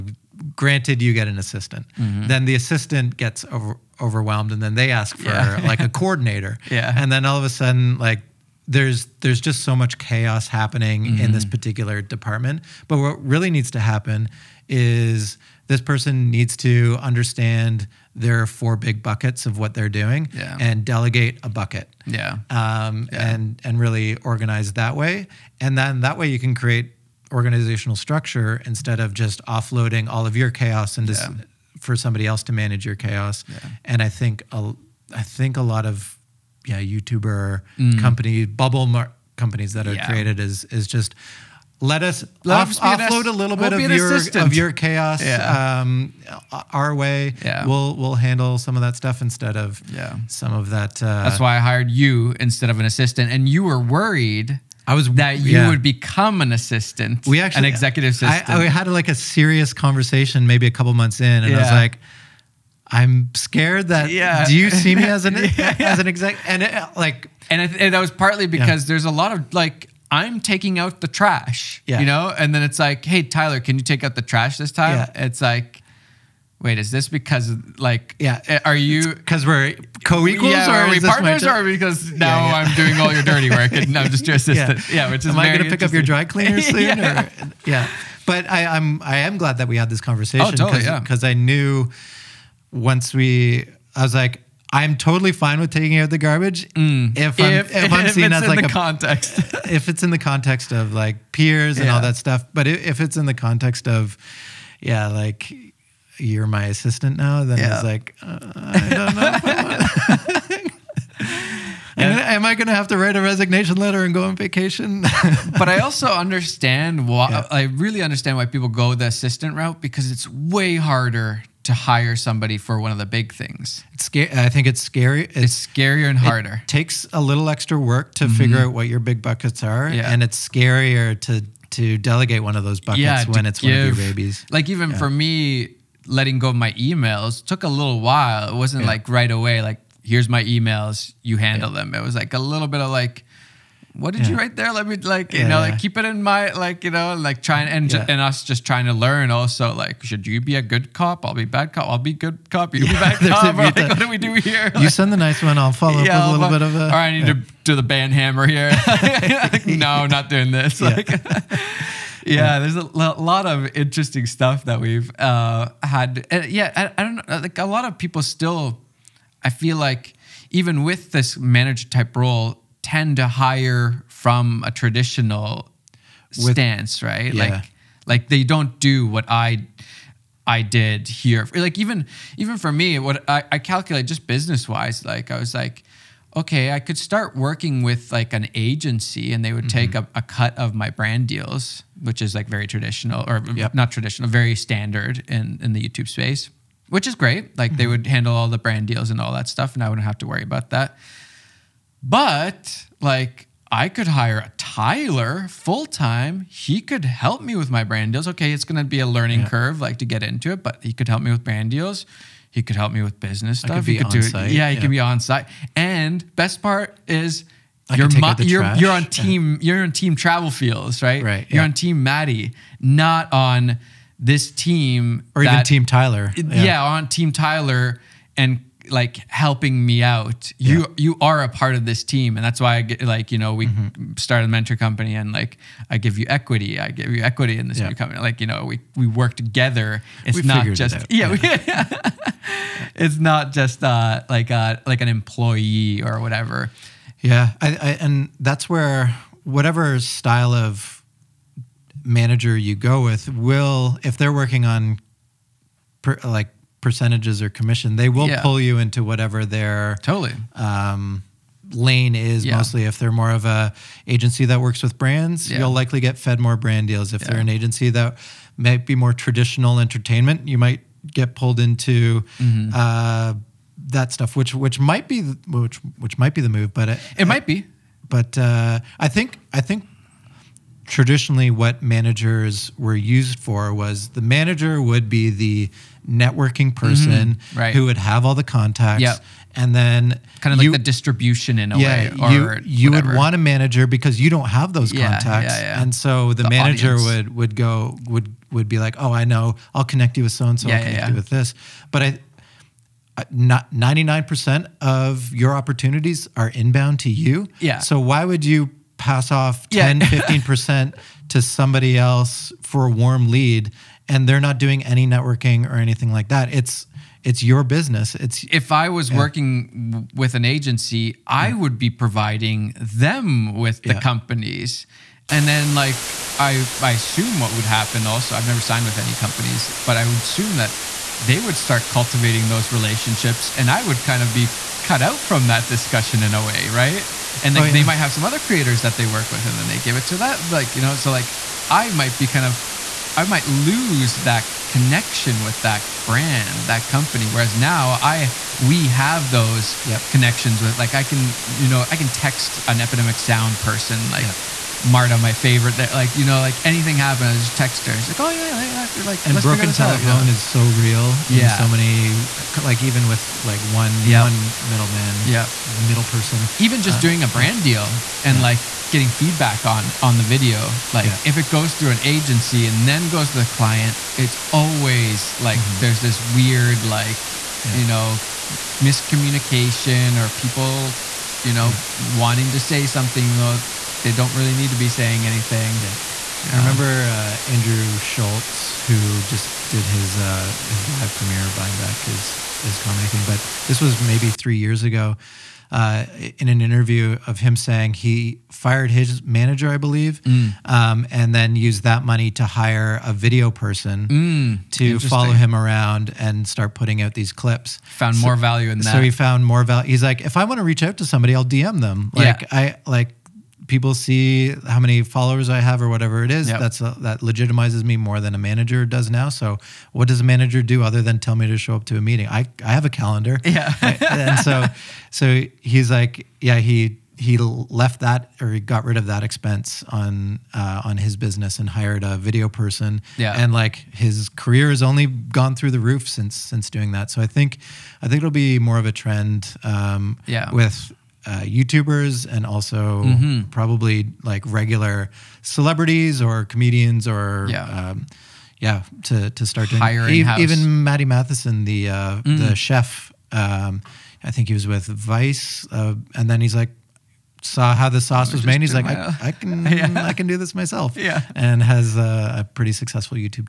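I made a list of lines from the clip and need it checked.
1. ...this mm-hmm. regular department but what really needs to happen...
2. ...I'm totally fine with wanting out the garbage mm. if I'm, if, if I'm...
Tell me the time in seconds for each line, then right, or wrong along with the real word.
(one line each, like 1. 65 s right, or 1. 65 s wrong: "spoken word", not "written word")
1. 11 s wrong: "particular", not "regular"
2. 94 s wrong: "taking", not "wanting".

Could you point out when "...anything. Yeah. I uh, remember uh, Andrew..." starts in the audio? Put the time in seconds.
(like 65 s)
385 s.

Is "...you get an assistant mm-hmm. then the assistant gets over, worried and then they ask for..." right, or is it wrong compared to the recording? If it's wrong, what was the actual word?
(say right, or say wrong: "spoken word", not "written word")
wrong: "overwhelmed", not "worried".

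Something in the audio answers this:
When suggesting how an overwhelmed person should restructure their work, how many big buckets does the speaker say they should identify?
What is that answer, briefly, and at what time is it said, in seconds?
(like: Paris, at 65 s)
4, at 18 s.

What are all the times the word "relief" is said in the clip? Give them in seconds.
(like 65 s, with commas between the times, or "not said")
not said.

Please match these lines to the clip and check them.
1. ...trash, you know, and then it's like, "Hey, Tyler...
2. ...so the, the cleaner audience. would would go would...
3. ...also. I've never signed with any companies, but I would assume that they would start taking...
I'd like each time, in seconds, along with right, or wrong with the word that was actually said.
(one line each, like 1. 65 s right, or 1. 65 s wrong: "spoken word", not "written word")
1. 71 s right
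2. 295 s wrong: "manager", not "cleaner"
3. 328 s wrong: "cultivating", not "taking".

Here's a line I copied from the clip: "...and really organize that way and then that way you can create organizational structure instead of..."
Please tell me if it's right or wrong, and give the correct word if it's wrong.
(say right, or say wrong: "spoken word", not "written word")
right.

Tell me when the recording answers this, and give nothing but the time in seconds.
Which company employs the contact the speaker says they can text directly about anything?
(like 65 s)
352 s.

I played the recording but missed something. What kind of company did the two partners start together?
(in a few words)
A mentor company.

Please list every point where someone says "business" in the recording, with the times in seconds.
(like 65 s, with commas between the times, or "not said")
184 s, 213 s, 317 s, 431 s.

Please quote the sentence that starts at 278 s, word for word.
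But uh, I think I think traditionally what managers were used for was the manager would be the networking mm-hmm.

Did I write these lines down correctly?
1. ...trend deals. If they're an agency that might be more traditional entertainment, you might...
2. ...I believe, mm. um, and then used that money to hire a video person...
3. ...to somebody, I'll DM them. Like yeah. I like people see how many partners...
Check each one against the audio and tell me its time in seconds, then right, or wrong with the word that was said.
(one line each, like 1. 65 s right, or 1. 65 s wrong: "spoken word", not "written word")
1. 266 s wrong: "brand", not "trend"
2. 399 s right
3. 410 s wrong: "followers", not "partners".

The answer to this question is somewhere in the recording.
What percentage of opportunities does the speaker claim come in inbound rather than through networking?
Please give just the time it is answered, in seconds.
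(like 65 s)
303 s.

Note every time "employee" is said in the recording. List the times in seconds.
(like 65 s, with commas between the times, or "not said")
245 s.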